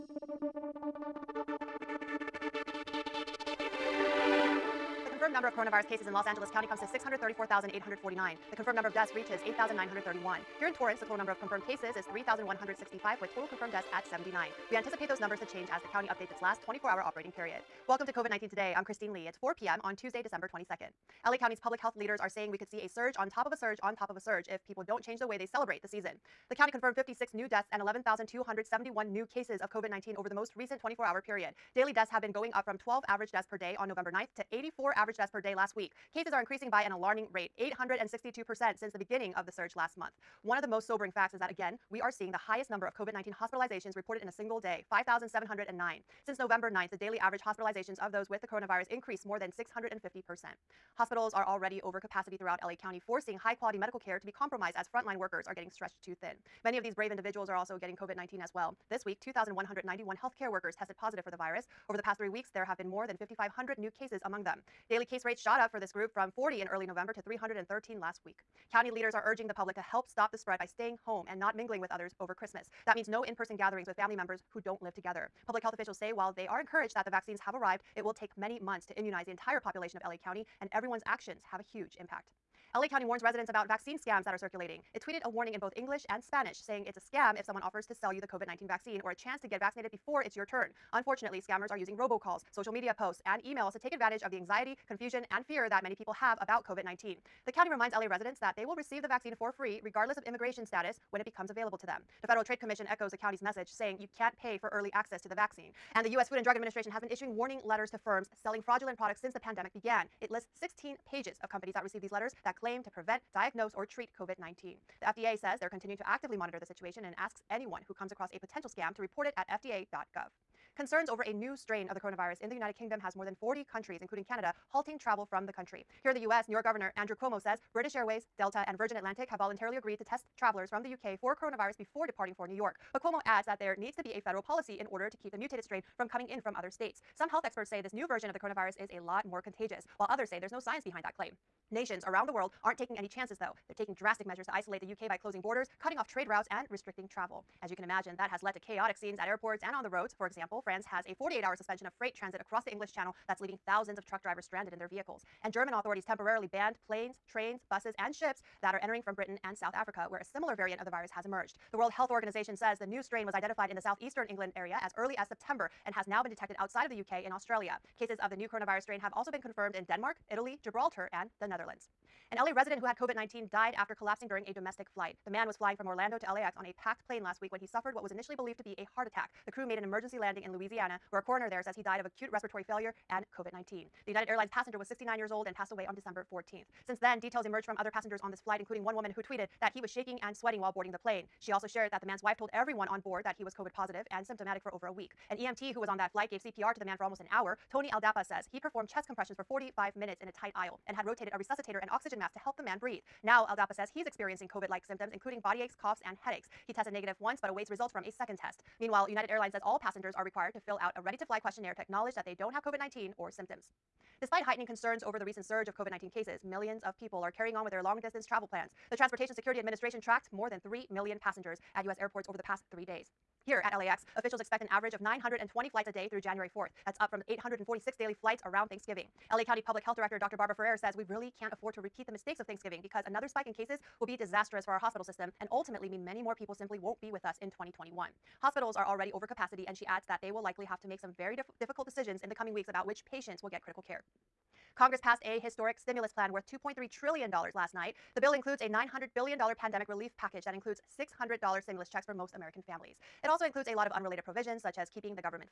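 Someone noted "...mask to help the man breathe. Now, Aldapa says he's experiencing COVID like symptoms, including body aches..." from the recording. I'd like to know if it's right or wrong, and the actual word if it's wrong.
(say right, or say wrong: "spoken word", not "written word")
right.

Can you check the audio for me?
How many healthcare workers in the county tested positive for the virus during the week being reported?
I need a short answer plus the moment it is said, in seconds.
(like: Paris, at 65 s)
2,191, at 59 s.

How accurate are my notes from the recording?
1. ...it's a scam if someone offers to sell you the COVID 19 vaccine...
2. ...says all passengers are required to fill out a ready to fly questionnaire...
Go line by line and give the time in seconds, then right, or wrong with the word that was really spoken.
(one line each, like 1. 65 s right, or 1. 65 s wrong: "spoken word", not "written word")
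1. 86 s right
2. 209 s right.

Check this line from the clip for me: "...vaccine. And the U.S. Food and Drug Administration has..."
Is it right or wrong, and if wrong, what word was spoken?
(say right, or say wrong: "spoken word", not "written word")
right.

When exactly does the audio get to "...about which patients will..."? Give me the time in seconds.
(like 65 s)
242 s.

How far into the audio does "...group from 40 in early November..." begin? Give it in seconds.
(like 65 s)
65 s.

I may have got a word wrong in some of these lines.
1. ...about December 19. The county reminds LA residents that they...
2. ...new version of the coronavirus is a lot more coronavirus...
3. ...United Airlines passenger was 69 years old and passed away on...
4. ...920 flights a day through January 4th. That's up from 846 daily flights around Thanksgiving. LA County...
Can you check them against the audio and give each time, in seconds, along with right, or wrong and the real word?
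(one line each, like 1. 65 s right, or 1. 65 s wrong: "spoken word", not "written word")
1. 96 s wrong: "COVID", not "December"
2. 137 s wrong: "contagious", not "coronavirus"
3. 184 s right
4. 225 s right.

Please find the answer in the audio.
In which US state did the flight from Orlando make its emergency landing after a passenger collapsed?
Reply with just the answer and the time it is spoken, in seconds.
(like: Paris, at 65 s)
Louisiana, at 180 s.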